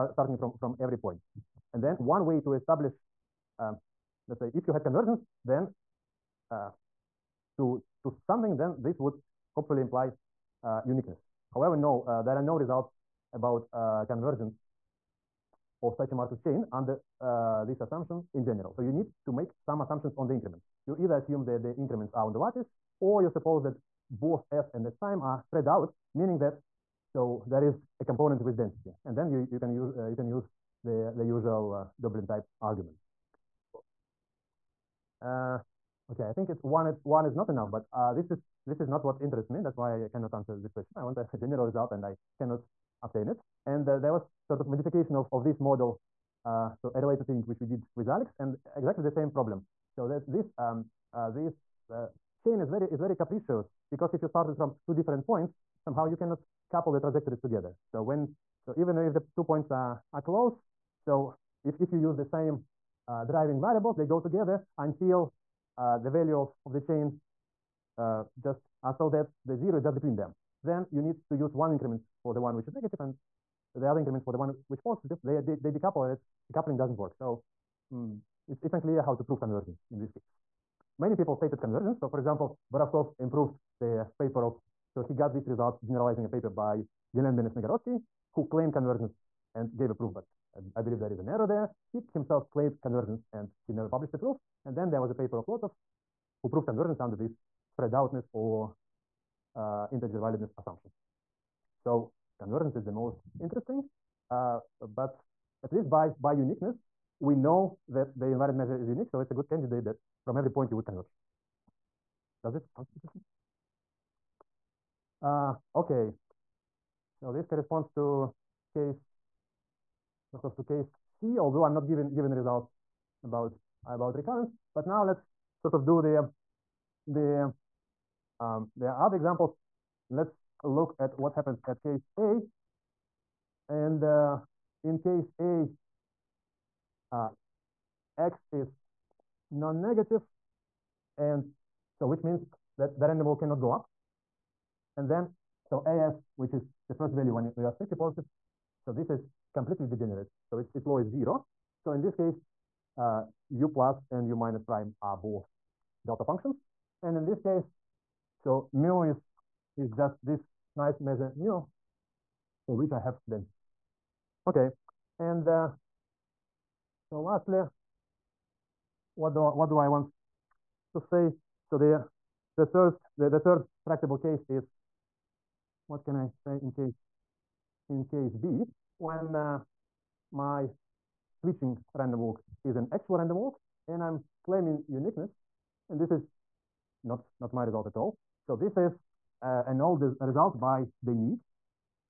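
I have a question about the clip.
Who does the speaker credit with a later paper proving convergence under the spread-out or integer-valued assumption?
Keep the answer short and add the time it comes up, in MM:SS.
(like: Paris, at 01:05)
Lotov, at 01:35.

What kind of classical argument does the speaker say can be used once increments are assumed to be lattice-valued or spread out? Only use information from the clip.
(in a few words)
Doeblin type argument.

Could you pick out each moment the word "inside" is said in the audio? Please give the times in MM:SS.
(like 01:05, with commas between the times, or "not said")
not said.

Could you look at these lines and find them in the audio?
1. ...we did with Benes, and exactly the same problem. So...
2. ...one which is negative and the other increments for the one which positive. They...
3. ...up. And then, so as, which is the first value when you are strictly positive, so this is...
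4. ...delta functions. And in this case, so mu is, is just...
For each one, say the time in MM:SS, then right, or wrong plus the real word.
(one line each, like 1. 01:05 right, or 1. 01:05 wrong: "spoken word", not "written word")
1. 00:47 wrong: "Alex", not "Benes"
2. 01:12 right
3. 02:23 right
4. 02:36 right.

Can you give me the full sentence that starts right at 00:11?
However, no, uh, there are no results about uh, convergence of such a Markov chain under uh, this assumption in general.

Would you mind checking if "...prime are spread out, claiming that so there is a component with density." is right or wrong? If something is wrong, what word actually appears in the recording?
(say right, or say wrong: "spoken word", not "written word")
wrong: "meaning", not "claiming".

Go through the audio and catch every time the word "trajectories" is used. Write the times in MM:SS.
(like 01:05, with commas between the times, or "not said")
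00:56.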